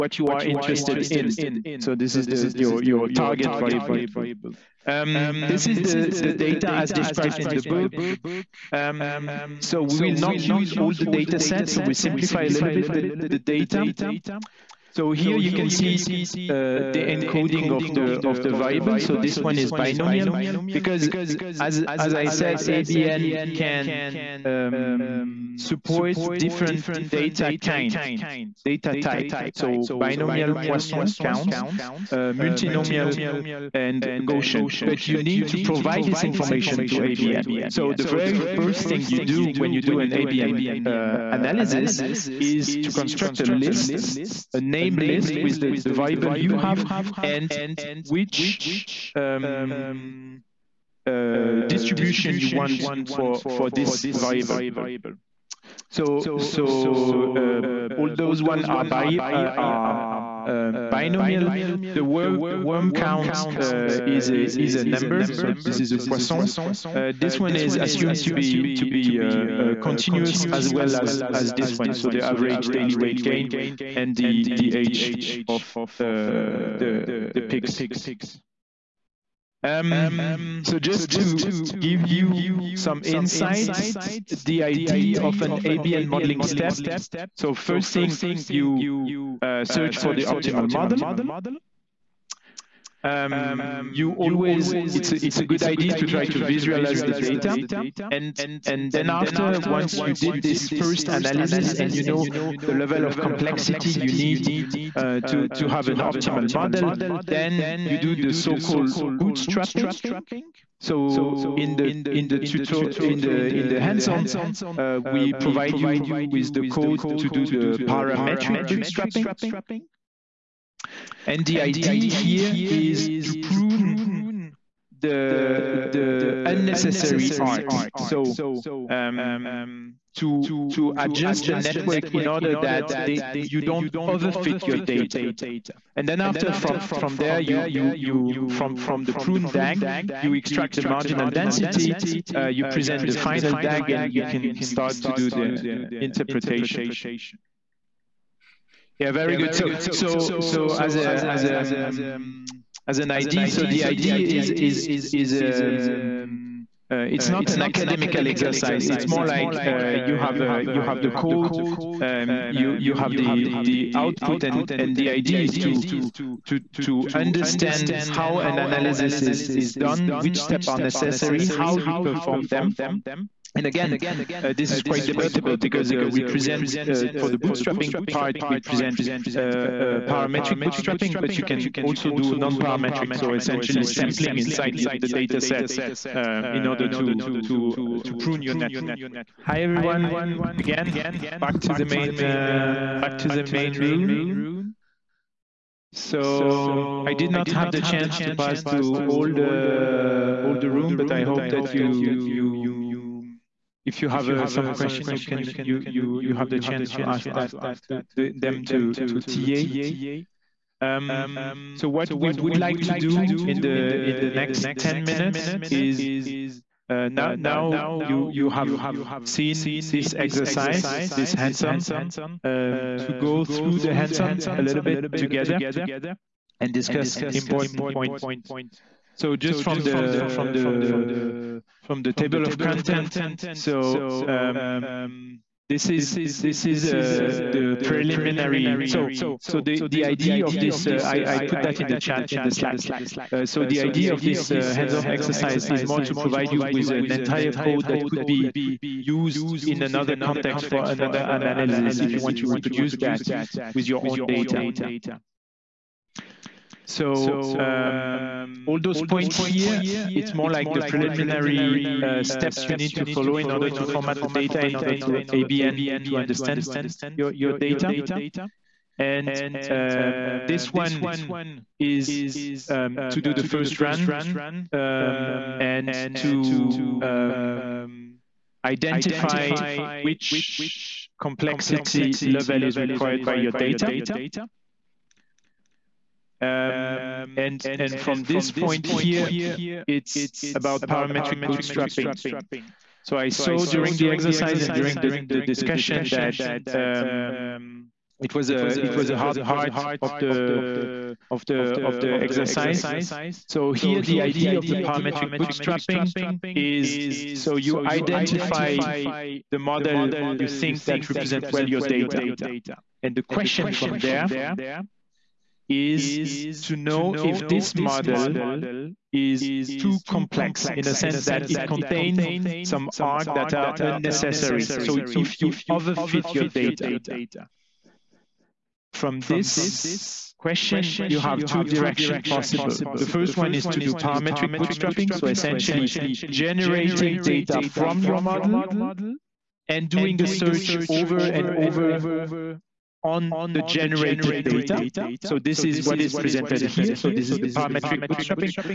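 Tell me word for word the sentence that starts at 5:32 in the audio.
The first one is to do parametric bootstrapping.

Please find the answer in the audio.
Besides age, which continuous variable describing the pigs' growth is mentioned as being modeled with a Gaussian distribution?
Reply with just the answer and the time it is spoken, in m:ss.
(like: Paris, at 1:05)
average daily weight gain, at 1:12.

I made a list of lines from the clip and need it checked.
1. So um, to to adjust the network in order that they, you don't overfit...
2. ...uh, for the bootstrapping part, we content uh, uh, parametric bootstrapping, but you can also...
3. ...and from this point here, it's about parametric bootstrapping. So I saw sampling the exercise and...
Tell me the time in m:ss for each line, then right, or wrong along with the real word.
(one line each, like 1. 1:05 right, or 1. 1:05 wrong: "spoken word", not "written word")
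1. 2:07 right
2. 2:56 wrong: "present", not "content"
3. 4:47 wrong: "during", not "sampling".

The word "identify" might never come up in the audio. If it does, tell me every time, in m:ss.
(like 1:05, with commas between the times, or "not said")
4:38, 5:07.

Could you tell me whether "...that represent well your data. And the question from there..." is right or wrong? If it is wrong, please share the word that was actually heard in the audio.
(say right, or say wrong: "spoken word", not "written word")
right.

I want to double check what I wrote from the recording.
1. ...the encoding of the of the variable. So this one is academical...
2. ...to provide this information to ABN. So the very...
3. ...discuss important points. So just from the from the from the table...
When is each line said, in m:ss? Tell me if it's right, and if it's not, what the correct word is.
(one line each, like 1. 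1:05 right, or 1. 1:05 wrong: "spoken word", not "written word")
1. 0:16 wrong: "binomial", not "academical"
2. 0:35 right
3. 3:46 right.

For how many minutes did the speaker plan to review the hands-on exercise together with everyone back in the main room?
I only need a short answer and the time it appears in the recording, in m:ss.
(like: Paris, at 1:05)
10, at 3:34.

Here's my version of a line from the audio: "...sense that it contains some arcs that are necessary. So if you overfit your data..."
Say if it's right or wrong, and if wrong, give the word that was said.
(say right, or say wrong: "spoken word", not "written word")
wrong: "unnecessary", not "necessary".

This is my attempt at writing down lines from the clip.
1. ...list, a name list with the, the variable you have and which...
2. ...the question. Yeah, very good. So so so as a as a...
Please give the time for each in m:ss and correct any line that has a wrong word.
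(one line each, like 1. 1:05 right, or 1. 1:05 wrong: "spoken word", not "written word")
1. 0:43 right
2. 2:25 wrong: "interpretation", not "question".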